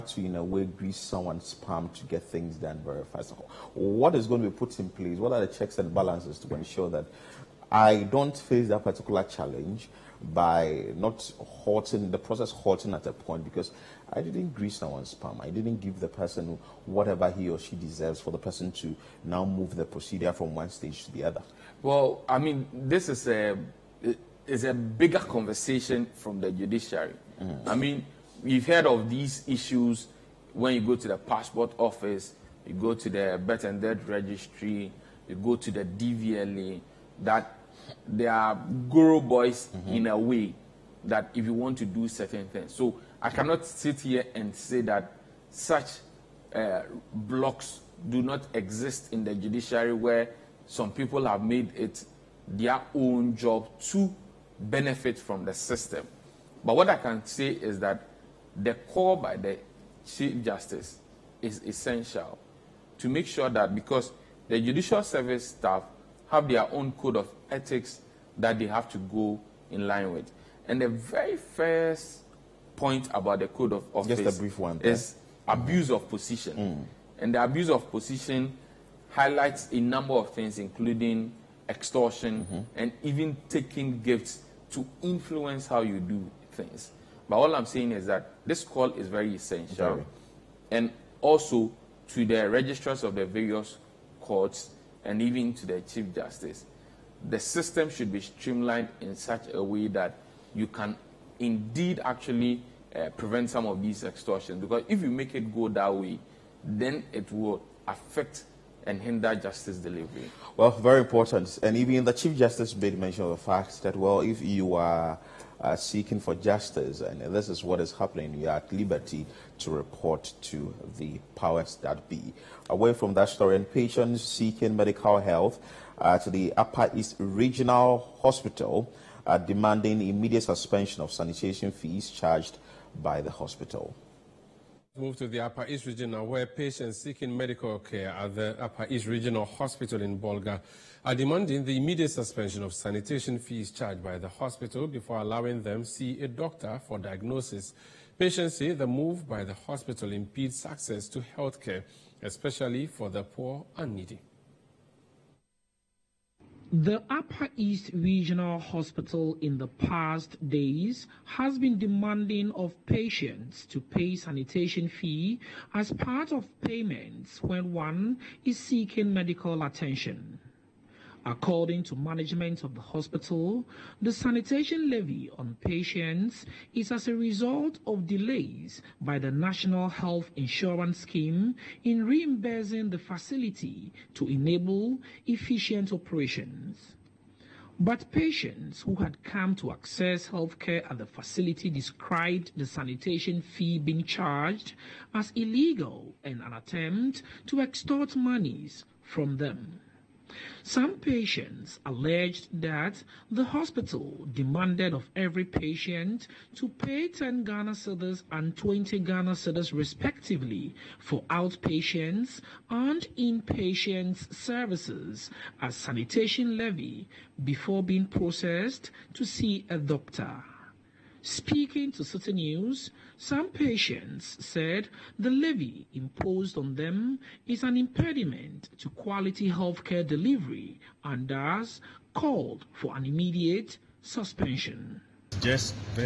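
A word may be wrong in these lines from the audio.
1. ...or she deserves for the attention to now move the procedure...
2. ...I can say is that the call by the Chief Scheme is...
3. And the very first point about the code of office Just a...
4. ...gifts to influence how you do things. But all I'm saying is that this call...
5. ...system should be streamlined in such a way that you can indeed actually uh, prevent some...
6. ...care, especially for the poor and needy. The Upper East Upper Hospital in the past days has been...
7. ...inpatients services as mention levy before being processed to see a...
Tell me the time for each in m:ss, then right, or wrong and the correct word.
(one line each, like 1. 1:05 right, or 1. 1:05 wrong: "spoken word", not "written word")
1. 0:17 wrong: "person", not "attention"
2. 0:56 wrong: "Justice", not "Scheme"
3. 1:10 right
4. 1:24 right
5. 1:37 right
6. 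2:31 wrong: "Regional", not "Upper"
7. 3:33 wrong: "sanitation", not "mention".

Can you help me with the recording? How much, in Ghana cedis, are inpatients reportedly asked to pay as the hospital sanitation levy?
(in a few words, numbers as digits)
20 Ghana cedis.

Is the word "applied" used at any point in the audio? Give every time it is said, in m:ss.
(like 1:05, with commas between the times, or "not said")
not said.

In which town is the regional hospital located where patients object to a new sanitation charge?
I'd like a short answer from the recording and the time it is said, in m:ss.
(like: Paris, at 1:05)
Bolga, at 2:20.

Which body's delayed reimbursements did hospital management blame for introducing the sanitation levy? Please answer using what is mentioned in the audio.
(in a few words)
National Health Insurance Scheme.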